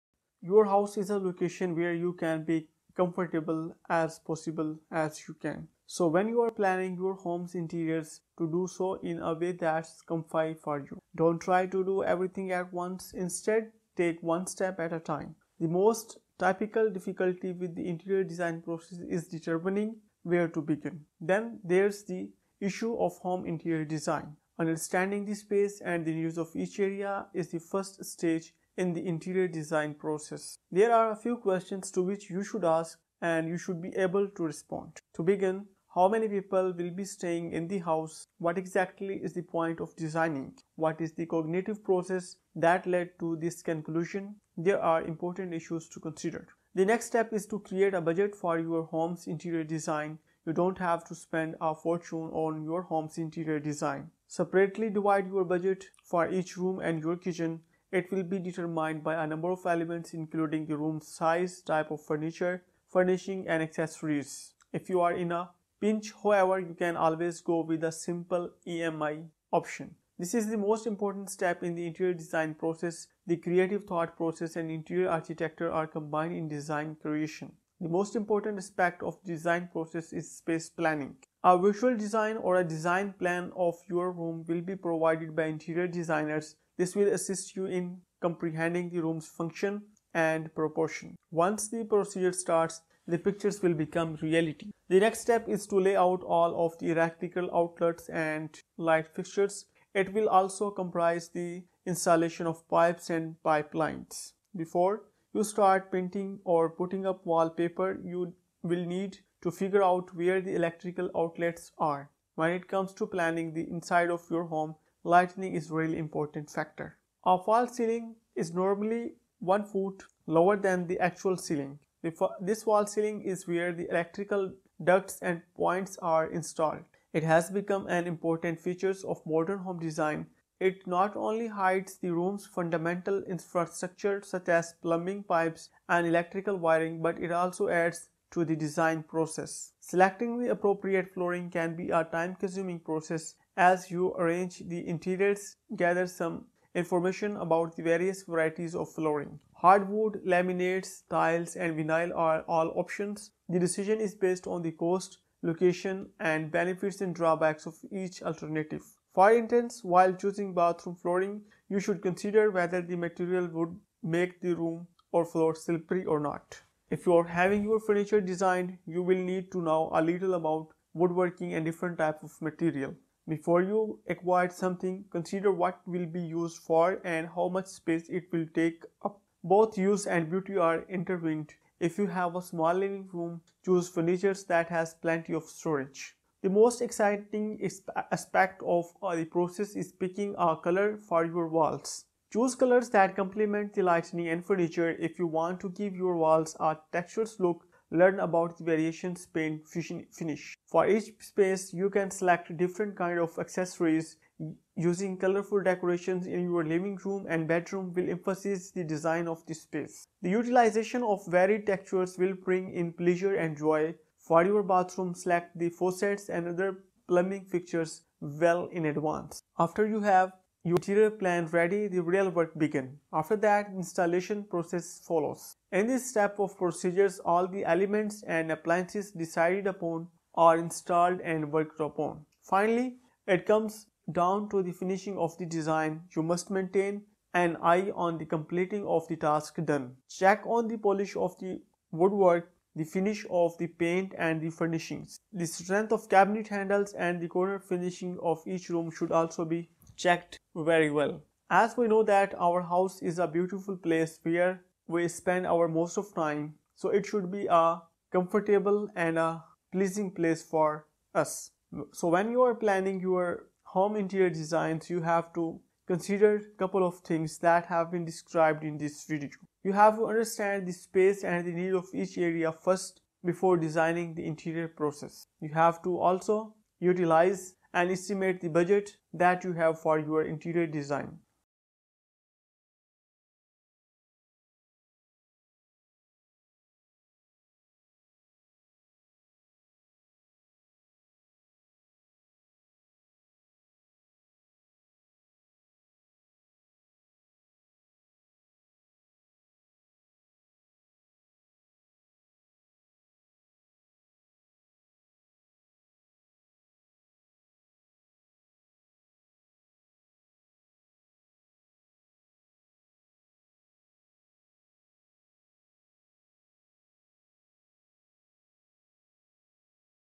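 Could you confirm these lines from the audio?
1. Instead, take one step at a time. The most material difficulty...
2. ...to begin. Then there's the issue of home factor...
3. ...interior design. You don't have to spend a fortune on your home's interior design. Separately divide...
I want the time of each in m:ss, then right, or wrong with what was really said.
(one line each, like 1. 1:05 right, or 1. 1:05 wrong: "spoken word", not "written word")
1. 0:13 wrong: "typical", not "material"
2. 0:20 wrong: "interior", not "factor"
3. 0:49 right.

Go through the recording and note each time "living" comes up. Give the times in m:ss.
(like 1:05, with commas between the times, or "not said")
3:02, 3:26.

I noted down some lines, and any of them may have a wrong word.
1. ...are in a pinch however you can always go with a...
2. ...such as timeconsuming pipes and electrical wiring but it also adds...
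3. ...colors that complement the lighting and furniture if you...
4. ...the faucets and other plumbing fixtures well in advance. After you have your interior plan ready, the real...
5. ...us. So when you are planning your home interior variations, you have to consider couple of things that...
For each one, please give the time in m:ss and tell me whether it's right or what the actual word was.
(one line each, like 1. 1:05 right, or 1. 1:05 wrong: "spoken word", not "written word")
1. 1:05 right
2. 2:14 wrong: "plumbing", not "timeconsuming"
3. 3:12 right
4. 3:35 right
5. 4:21 wrong: "designs", not "variations".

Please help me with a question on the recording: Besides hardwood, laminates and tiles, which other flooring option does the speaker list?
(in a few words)
Vinyl.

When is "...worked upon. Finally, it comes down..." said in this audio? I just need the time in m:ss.
3:51.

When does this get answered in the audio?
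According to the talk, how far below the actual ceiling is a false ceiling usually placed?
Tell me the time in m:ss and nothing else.
1:59.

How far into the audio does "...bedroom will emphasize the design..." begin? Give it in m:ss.
3:27.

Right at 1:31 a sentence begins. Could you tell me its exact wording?
Once the procedure starts, the pictures will become reality.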